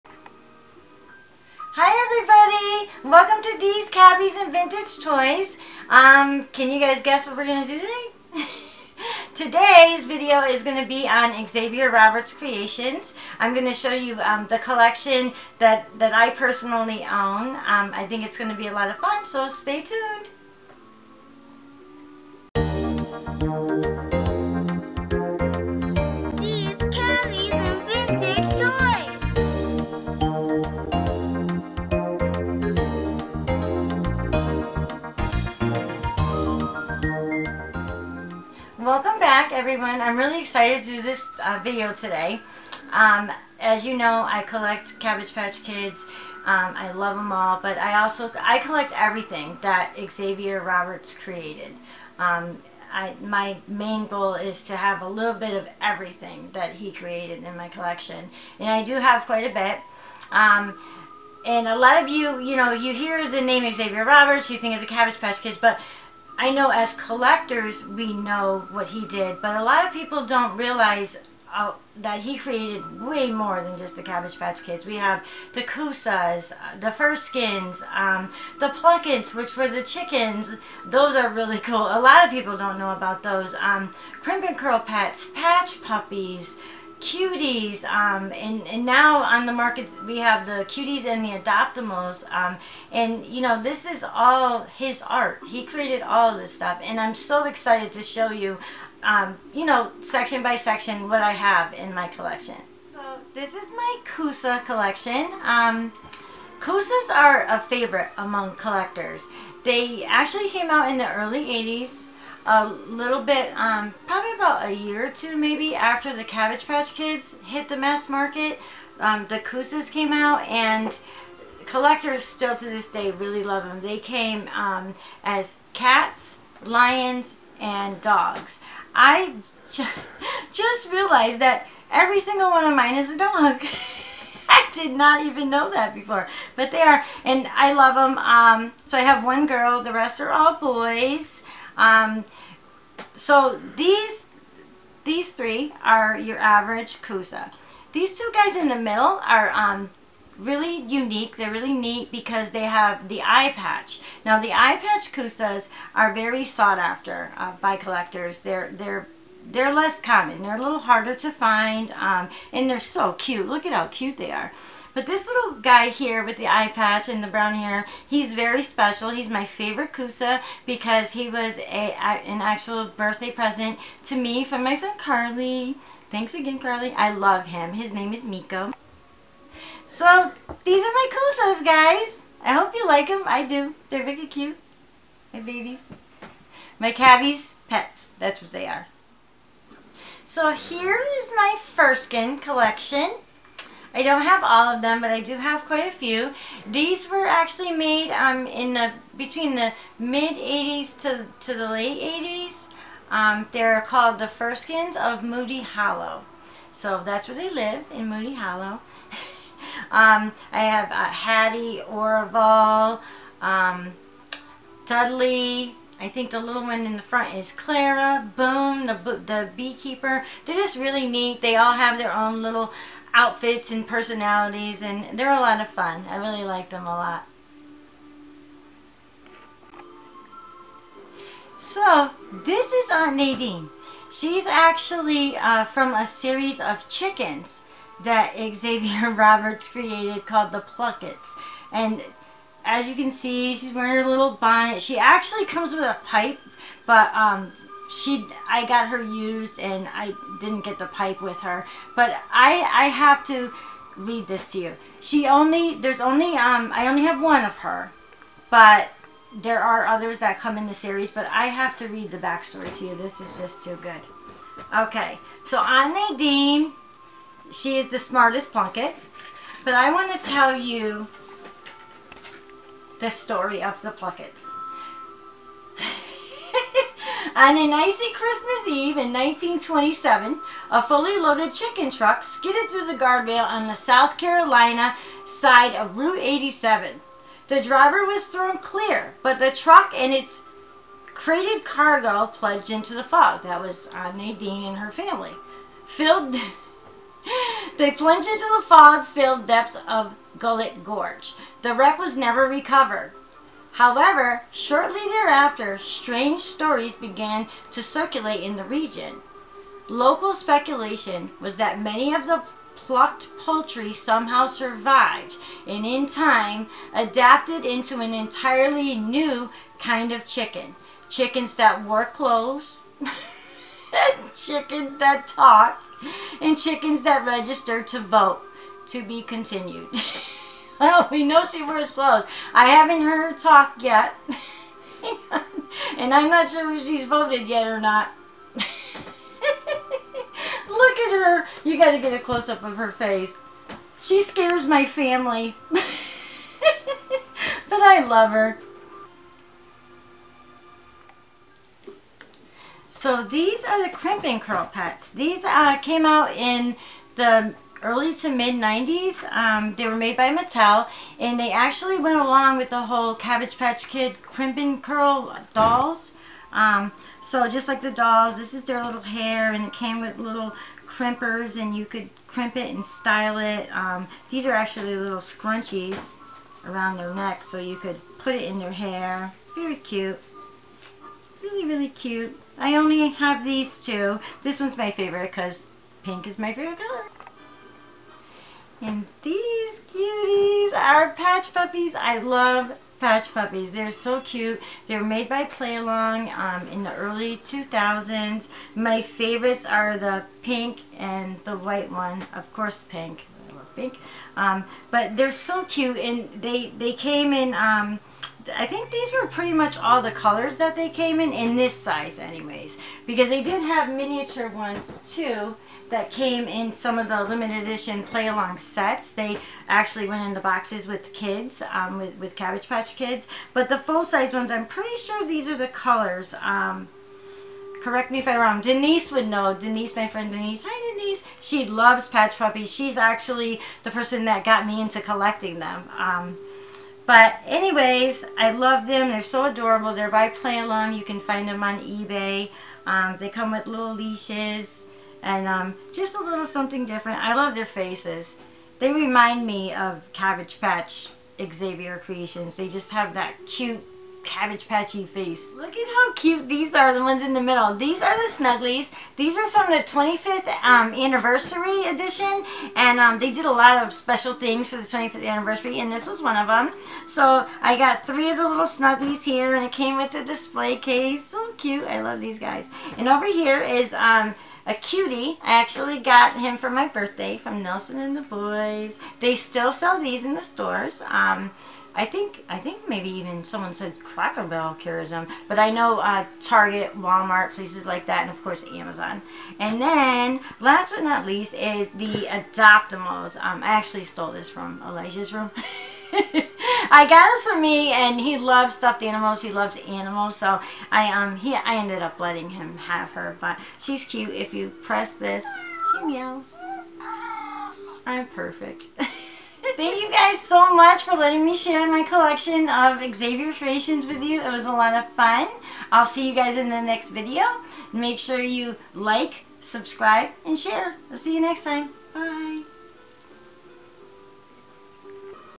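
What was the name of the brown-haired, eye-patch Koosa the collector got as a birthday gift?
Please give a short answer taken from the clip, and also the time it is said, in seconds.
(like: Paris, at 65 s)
Miko, at 177 s.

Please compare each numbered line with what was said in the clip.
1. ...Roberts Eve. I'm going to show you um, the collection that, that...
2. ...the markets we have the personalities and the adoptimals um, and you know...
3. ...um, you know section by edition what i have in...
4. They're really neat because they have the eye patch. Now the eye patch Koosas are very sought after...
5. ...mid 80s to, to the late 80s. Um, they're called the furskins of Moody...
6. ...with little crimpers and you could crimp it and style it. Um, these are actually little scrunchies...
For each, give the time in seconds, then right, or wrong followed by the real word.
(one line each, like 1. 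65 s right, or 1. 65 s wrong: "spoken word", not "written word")
1. 11 s wrong: "Creations", not "Eve"
2. 89 s wrong: "cuties", not "personalities"
3. 99 s wrong: "section", not "edition"
4. 151 s right
5. 199 s right
6. 370 s right.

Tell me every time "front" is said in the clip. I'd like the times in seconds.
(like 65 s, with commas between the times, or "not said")
217 s.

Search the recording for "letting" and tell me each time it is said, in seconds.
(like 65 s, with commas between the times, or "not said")
502 s, 511 s.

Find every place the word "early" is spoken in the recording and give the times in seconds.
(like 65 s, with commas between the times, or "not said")
111 s, 357 s, 396 s.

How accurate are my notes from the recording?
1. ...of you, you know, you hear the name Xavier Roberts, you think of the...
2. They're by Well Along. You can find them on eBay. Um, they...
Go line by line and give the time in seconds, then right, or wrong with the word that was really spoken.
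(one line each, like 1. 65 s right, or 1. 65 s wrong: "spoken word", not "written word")
1. 62 s right
2. 439 s wrong: "Play", not "Well".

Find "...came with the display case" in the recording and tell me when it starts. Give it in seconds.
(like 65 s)
469 s.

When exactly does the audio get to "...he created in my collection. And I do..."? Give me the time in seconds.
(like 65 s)
56 s.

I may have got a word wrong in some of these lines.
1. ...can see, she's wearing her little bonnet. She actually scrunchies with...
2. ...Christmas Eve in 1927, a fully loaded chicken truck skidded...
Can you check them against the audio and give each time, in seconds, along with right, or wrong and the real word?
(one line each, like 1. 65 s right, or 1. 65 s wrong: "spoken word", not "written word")
1. 242 s wrong: "comes", not "scrunchies"
2. 278 s right.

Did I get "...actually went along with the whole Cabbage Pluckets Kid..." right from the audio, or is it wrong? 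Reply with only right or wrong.
wrong.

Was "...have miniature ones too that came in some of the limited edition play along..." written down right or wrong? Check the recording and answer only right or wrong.
right.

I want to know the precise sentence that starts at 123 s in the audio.
They came um, as cats, lions, and dogs.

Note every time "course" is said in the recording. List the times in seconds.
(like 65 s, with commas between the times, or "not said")
402 s, 488 s.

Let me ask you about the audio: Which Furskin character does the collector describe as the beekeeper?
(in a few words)
Boom.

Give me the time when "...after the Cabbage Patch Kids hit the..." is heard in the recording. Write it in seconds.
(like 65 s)
115 s.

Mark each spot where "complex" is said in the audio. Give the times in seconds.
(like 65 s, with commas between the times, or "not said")
not said.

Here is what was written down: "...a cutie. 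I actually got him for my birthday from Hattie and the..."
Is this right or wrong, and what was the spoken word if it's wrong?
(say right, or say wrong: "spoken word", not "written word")
wrong: "Nelson", not "Hattie".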